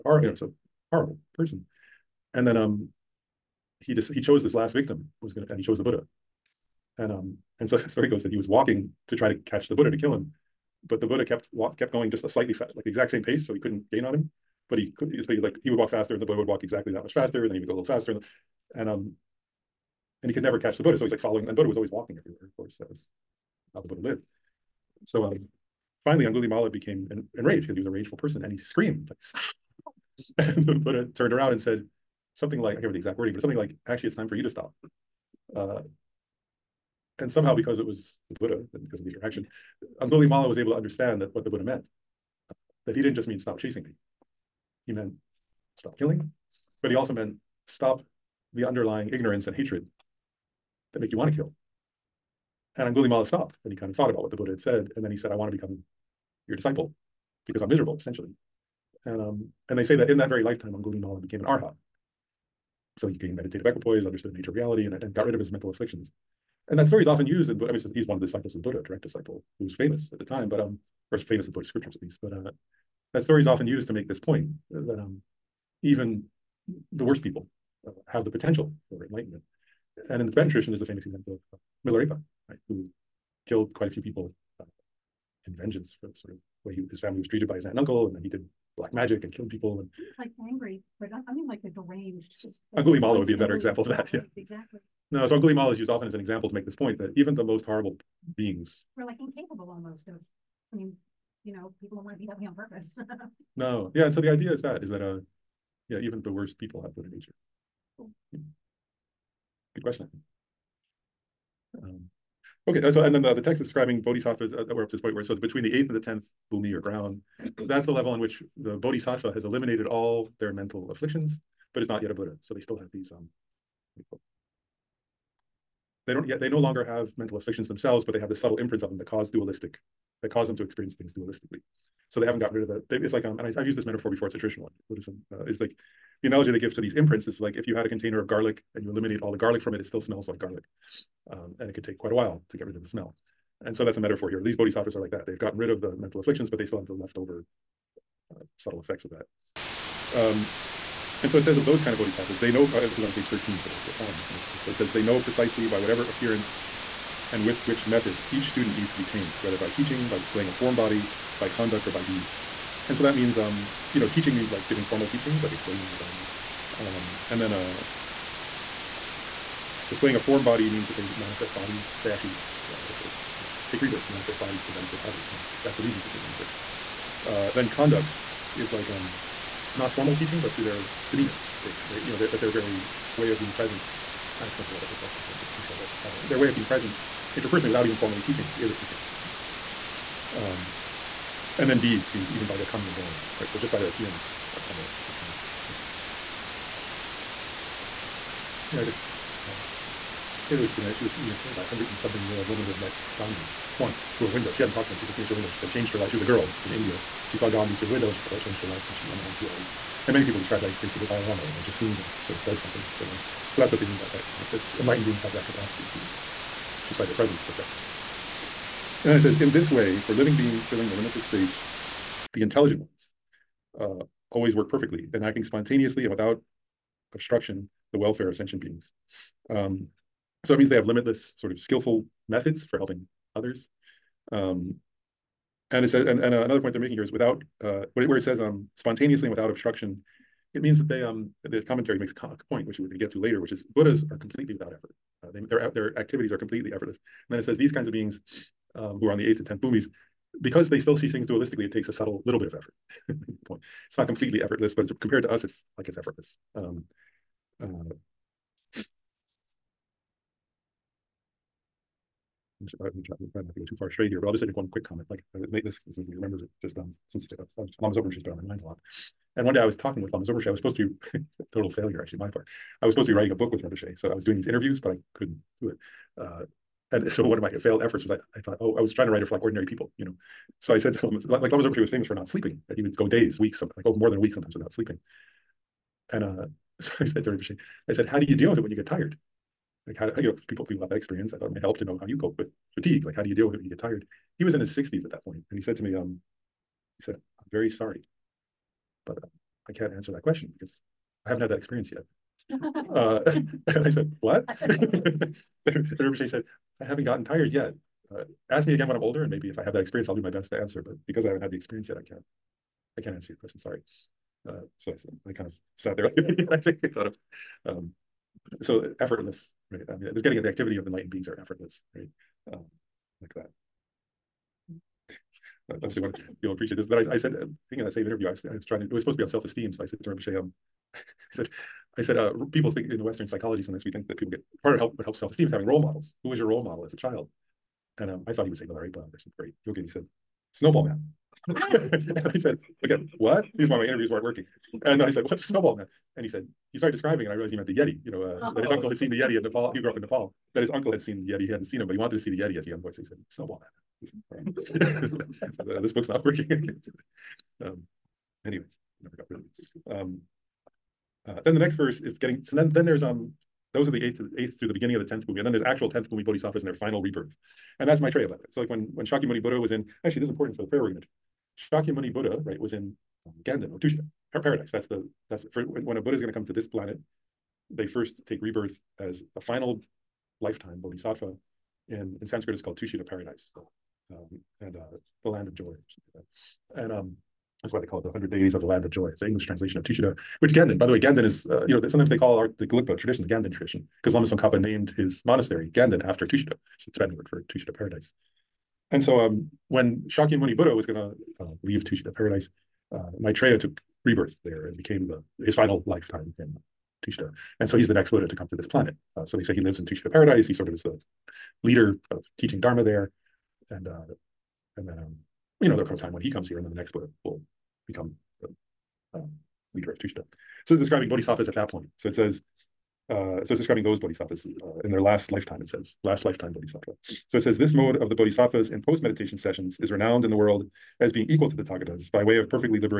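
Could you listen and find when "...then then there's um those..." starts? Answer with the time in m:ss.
6:02.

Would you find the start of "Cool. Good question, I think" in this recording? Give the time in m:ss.
1:47.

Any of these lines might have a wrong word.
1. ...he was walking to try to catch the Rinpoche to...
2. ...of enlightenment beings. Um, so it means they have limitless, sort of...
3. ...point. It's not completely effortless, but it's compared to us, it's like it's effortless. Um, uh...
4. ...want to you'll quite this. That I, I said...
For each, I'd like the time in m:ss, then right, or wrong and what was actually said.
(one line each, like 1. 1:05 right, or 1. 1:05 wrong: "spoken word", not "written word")
1. 0:08 wrong: "Buddha", not "Rinpoche"
2. 3:48 wrong: "sentient", not "enlightenment"
3. 4:13 right
4. 5:25 wrong: "appreciate", not "quite".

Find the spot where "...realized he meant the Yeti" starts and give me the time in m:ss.
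5:47.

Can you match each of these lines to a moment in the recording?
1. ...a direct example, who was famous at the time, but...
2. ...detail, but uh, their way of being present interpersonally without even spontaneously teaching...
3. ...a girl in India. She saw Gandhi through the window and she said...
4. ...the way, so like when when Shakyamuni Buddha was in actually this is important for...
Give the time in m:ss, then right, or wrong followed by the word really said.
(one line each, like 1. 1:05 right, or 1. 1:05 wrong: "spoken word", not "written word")
1. 1:08 wrong: "disciple", not "example"
2. 3:05 wrong: "formally", not "spontaneously"
3. 3:26 right
4. 6:08 right.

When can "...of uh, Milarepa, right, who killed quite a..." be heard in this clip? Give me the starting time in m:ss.
1:21.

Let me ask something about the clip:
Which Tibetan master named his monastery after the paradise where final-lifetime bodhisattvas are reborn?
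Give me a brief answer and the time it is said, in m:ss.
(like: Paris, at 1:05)
Lama Tsongkhapa, at 6:34.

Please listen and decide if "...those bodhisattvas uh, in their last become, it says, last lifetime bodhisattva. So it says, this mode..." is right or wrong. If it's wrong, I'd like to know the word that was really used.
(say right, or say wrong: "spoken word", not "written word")
wrong: "lifetime", not "become".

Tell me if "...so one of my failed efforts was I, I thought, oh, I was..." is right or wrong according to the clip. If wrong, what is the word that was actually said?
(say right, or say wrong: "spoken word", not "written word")
right.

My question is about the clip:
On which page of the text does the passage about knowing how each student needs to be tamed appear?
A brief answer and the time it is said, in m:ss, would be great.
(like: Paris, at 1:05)
13, at 2:33.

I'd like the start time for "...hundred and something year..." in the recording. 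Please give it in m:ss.
3:21.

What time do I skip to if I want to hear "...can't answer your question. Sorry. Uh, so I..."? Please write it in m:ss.
5:13.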